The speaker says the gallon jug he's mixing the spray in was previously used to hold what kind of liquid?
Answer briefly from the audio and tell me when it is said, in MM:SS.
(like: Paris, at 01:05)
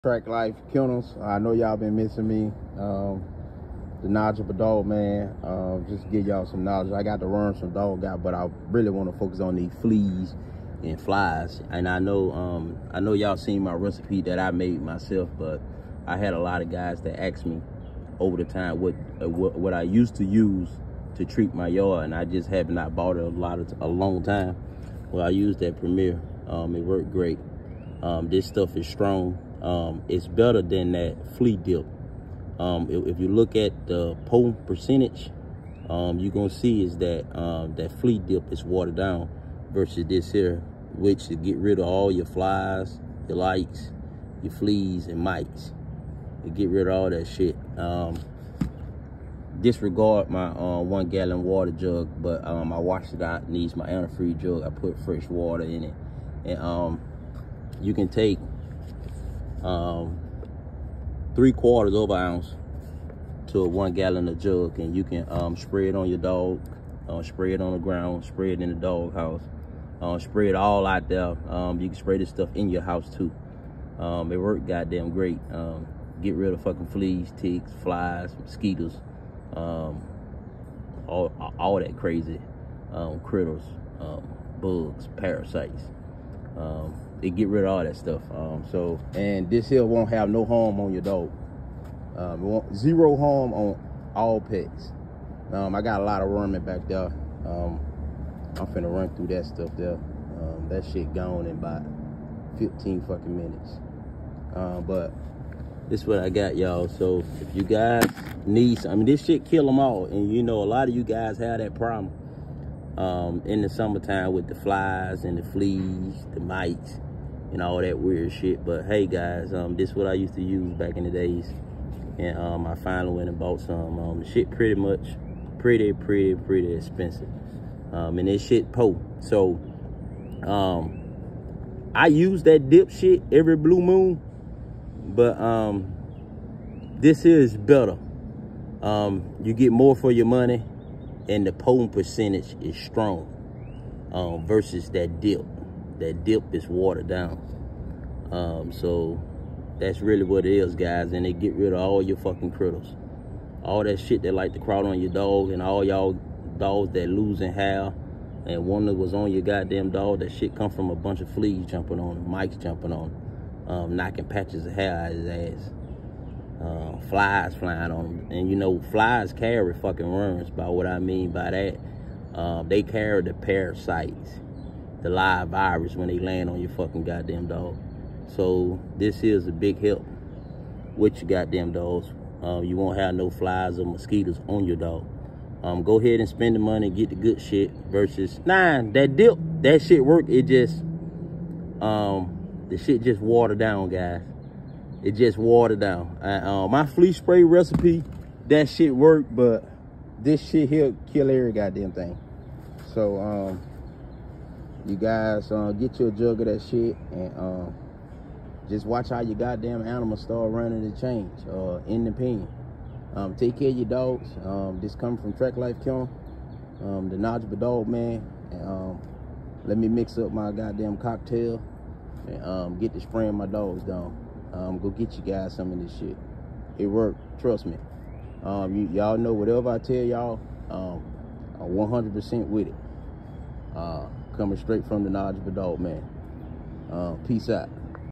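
Antifreeze, at 00:53.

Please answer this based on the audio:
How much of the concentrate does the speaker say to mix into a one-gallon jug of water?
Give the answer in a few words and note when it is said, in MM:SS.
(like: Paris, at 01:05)
3/4 ounce, at 01:01.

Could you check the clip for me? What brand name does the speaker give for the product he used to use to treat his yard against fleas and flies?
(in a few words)
Premier.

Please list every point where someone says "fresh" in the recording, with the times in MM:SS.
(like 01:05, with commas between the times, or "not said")
00:55.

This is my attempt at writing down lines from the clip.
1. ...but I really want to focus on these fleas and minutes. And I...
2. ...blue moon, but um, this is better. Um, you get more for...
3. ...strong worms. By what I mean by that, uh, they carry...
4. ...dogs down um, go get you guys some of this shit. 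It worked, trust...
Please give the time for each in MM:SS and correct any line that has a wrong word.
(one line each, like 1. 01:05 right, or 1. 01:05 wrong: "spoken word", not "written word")
1. 00:08 wrong: "flies", not "minutes"
2. 02:13 right
3. 02:49 wrong: "fucking", not "strong"
4. 03:43 right.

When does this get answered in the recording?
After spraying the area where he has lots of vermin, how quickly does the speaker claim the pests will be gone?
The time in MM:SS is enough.
01:42.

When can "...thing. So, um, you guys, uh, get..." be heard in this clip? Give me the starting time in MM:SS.
03:21.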